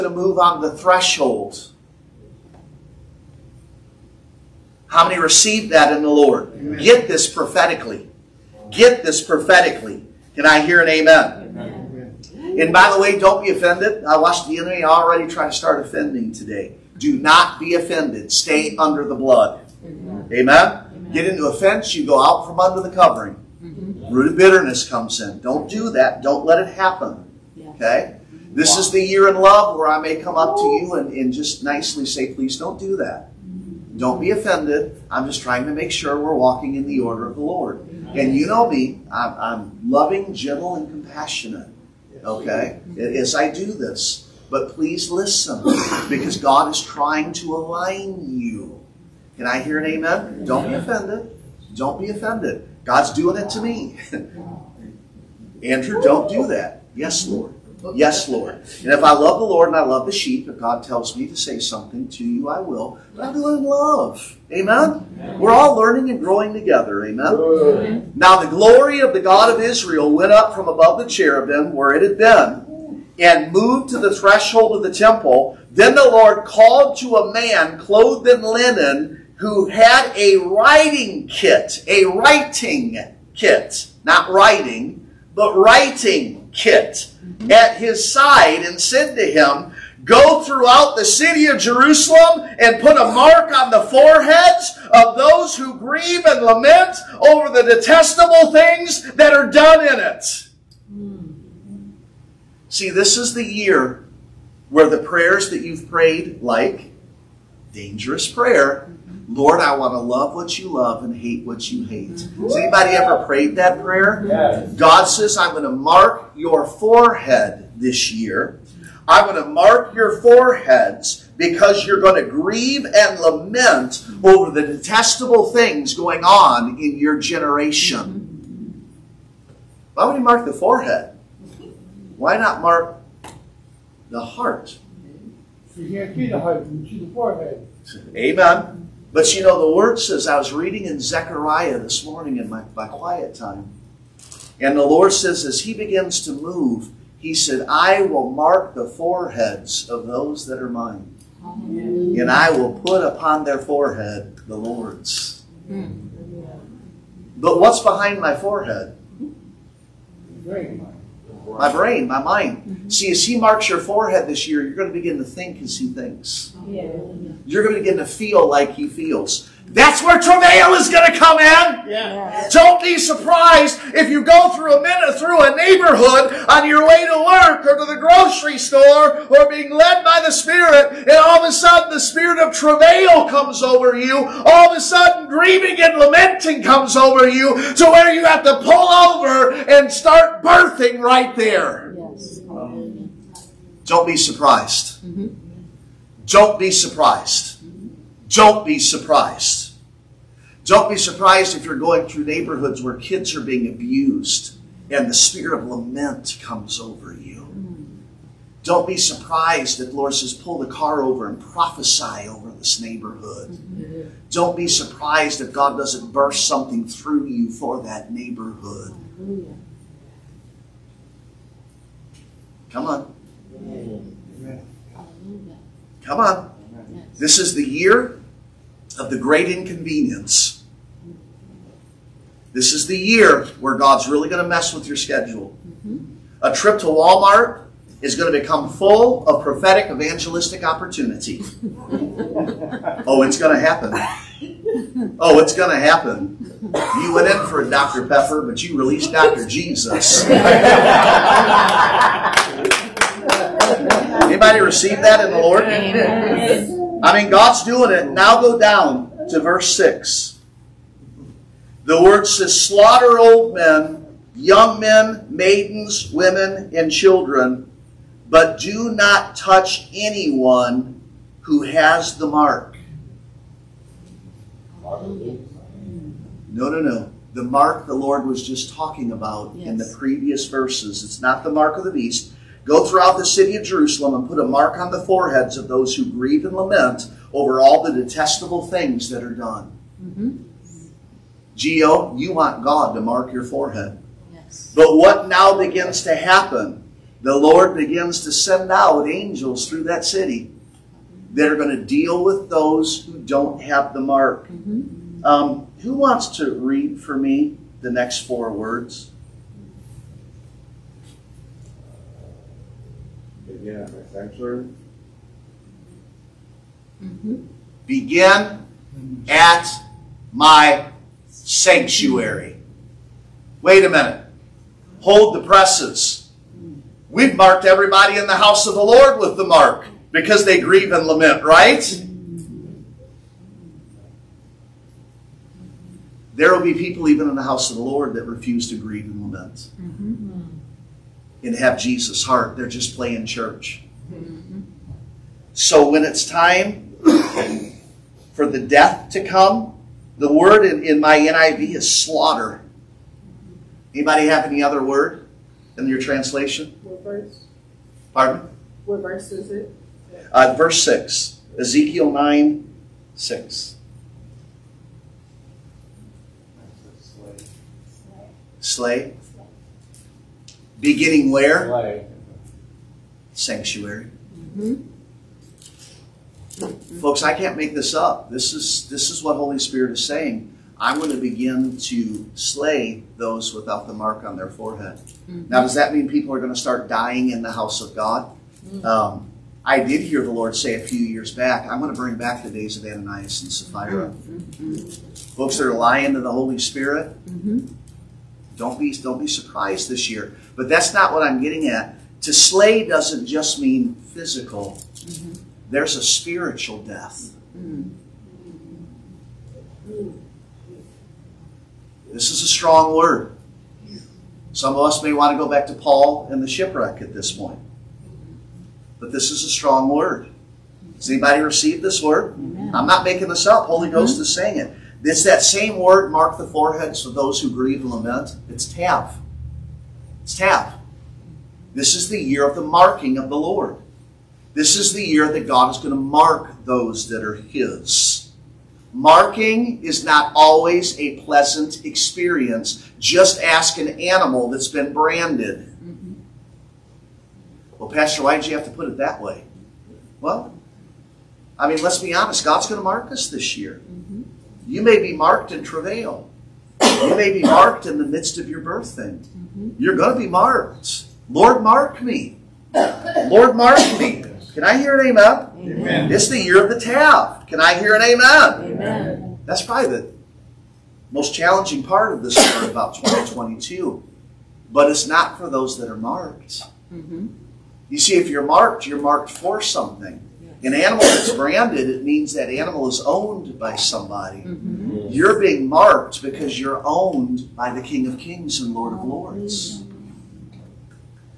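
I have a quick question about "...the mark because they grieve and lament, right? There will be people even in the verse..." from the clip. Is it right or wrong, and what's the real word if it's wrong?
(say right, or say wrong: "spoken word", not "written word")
wrong: "house", not "verse".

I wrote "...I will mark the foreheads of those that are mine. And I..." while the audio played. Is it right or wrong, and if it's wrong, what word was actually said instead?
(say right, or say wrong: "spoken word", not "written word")
right.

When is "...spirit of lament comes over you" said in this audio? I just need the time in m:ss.
3:25.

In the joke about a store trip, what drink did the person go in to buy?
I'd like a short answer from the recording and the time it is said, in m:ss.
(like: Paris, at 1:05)
Dr. Pepper, at 4:07.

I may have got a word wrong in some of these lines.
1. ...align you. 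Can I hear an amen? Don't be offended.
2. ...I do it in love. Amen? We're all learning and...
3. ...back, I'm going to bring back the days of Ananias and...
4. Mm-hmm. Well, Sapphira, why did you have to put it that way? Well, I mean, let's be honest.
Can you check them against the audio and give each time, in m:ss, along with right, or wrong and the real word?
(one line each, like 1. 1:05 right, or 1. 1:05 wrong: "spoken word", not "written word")
1. 0:47 right
2. 1:03 right
3. 6:31 right
4. 7:25 wrong: "Pastor", not "Sapphira".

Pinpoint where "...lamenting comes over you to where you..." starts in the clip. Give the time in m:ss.
3:05.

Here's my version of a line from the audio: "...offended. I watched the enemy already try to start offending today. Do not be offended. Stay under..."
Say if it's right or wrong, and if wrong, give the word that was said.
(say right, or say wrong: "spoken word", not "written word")
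right.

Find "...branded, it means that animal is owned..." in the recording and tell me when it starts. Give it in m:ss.
8:01.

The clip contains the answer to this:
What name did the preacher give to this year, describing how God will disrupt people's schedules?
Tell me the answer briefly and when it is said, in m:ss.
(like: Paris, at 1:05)
The year of the great inconvenience, at 3:47.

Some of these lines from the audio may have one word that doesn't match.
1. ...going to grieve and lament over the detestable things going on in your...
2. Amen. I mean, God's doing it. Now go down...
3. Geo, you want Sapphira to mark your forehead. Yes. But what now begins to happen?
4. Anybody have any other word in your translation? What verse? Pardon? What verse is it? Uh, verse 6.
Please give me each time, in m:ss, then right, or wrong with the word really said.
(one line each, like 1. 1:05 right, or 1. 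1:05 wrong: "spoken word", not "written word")
1. 2:02 right
2. 4:15 right
3. 4:51 wrong: "God", not "Sapphira"
4. 5:53 right.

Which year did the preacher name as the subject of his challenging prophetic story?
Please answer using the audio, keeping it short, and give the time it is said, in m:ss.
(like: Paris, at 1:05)
2022, at 7:52.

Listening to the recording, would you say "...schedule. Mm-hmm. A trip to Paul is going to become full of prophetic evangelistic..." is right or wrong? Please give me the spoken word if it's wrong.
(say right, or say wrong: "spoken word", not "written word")
wrong: "Walmart", not "Paul".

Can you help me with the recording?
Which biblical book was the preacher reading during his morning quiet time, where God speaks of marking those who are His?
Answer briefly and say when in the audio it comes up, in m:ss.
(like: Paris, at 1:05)
Zechariah, at 2:21.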